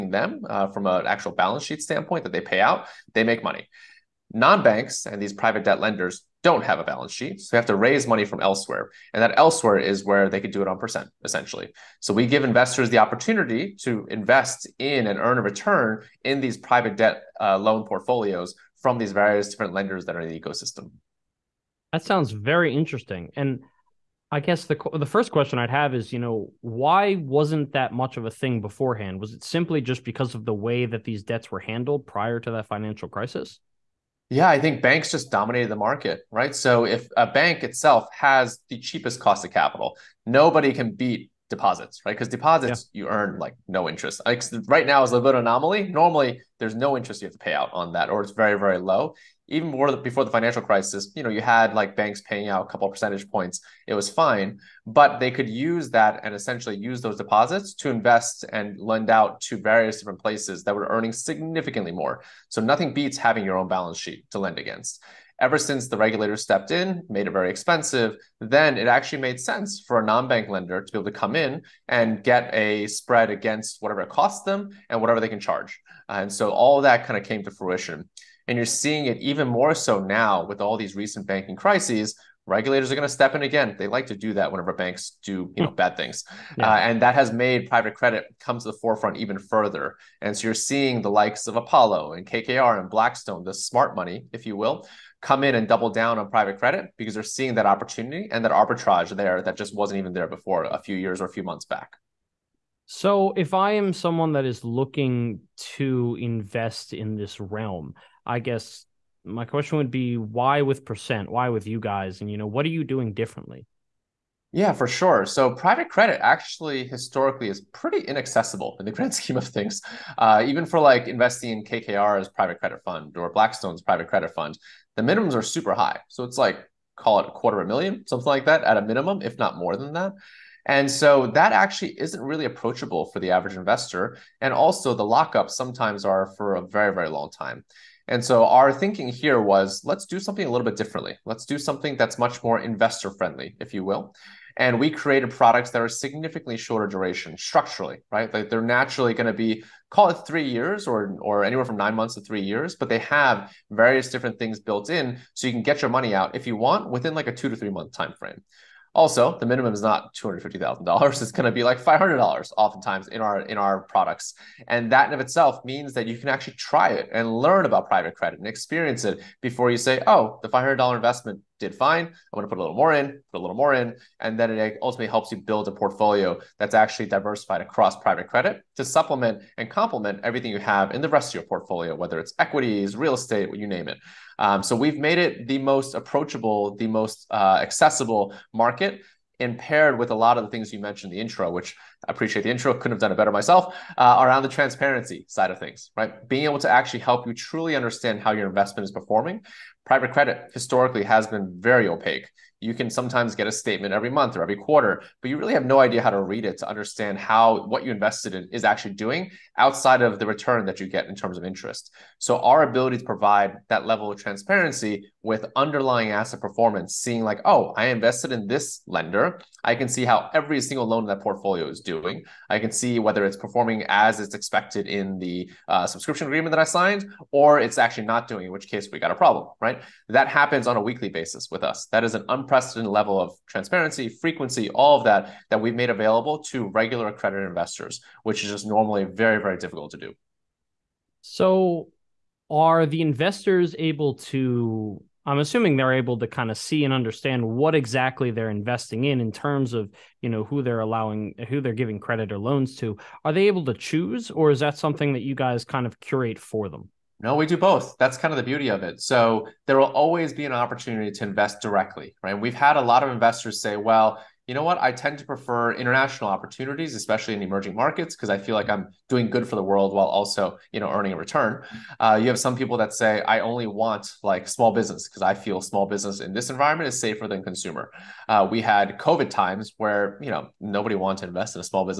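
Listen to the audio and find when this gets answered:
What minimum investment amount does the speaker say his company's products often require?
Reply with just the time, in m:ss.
2:41.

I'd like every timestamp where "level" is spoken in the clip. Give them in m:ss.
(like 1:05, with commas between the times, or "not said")
3:33, 3:52.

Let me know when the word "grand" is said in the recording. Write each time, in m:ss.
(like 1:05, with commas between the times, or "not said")
1:58.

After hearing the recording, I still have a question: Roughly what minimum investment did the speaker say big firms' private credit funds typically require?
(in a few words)
a quarter of a million.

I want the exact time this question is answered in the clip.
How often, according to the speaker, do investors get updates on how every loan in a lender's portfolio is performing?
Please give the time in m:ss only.
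3:50.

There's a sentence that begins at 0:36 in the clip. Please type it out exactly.
So if a bank itself has the cheapest cost of capital, nobody can beat deposits, right?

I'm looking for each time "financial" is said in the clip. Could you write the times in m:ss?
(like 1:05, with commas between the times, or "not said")
0:32, 0:50.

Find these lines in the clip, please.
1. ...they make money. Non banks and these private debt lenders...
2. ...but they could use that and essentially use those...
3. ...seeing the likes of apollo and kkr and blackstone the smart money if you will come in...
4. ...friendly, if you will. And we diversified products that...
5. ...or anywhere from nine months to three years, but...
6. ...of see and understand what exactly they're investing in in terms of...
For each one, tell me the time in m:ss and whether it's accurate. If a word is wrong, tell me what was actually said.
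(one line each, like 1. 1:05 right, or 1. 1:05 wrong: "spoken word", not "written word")
1. 0:03 right
2. 0:54 right
3. 1:30 right
4. 2:23 wrong: "created", not "diversified"
5. 2:31 right
6. 4:06 right.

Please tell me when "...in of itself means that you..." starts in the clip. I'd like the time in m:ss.
2:45.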